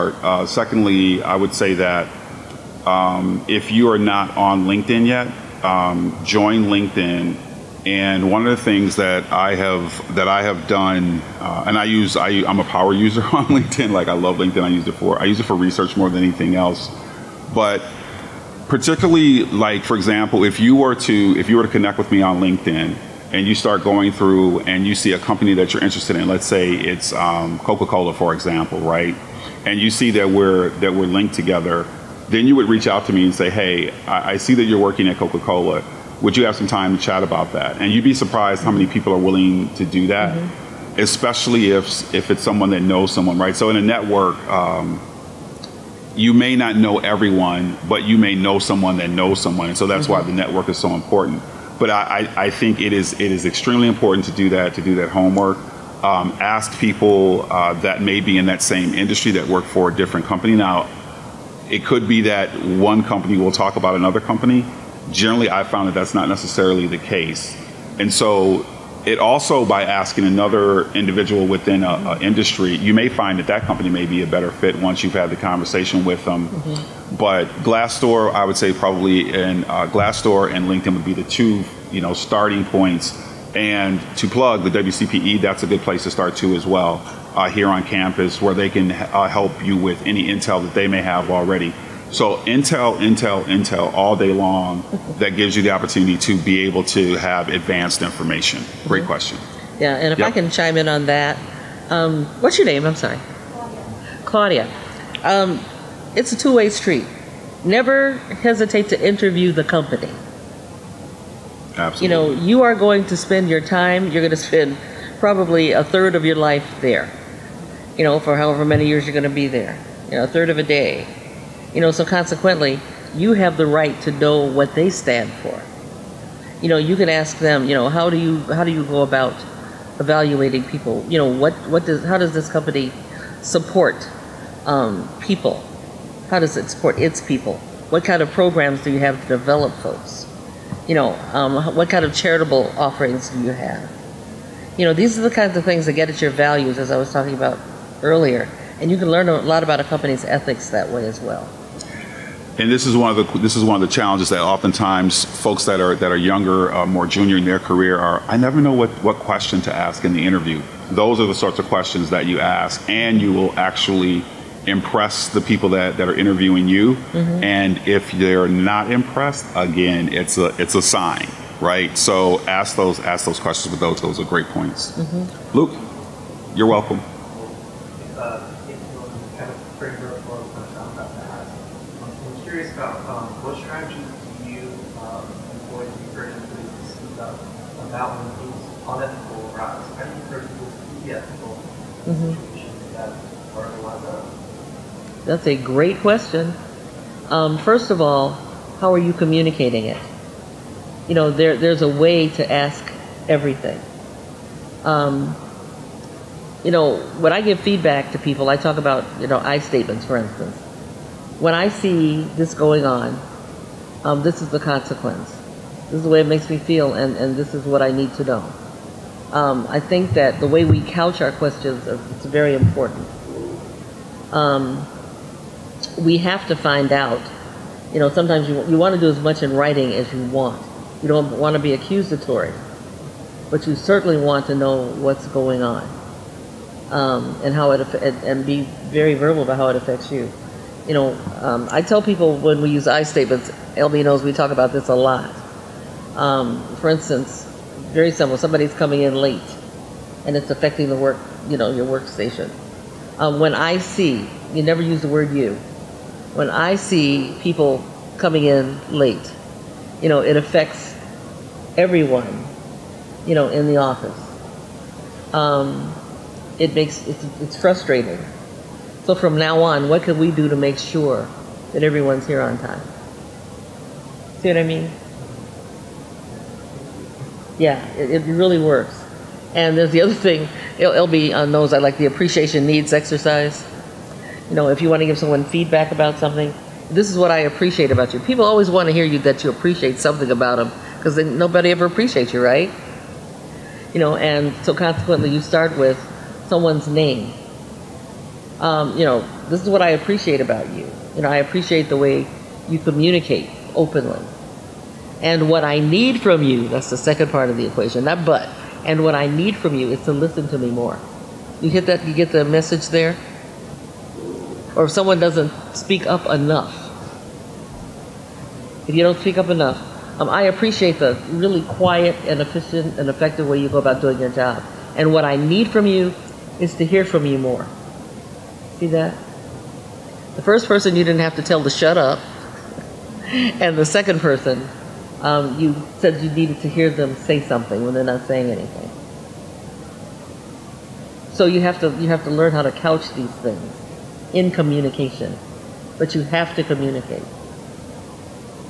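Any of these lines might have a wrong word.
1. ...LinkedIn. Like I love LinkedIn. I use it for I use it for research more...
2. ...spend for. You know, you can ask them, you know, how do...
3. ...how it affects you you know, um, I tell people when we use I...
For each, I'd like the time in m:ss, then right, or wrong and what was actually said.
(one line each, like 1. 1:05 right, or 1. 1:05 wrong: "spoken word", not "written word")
1. 0:13 right
2. 2:04 wrong: "stand", not "spend"
3. 3:59 right.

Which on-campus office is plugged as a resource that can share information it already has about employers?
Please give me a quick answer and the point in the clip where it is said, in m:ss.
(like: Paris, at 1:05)
WCPE, at 1:24.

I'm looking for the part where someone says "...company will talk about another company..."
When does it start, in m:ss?
1:03.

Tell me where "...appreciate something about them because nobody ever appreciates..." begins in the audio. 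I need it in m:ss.
4:49.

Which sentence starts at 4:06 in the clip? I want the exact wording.
Um, for instance, very simple, somebody's coming in late and it's affecting the work, you know, your workstation.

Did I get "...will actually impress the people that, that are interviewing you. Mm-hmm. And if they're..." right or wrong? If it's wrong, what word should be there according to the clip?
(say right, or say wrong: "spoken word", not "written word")
right.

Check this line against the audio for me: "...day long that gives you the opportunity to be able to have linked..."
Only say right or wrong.
wrong.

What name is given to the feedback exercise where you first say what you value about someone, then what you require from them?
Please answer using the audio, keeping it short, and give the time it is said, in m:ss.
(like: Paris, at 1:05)
appreciation needs exercise, at 4:42.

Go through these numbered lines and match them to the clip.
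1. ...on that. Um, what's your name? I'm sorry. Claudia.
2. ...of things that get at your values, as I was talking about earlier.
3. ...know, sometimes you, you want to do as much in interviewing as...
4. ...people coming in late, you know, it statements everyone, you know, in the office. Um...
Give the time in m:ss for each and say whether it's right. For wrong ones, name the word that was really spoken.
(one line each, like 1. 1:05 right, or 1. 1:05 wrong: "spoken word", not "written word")
1. 1:40 right
2. 2:25 right
3. 3:48 wrong: "writing", not "interviewing"
4. 4:17 wrong: "affects", not "statements".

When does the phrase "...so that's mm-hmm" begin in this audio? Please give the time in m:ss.
0:49.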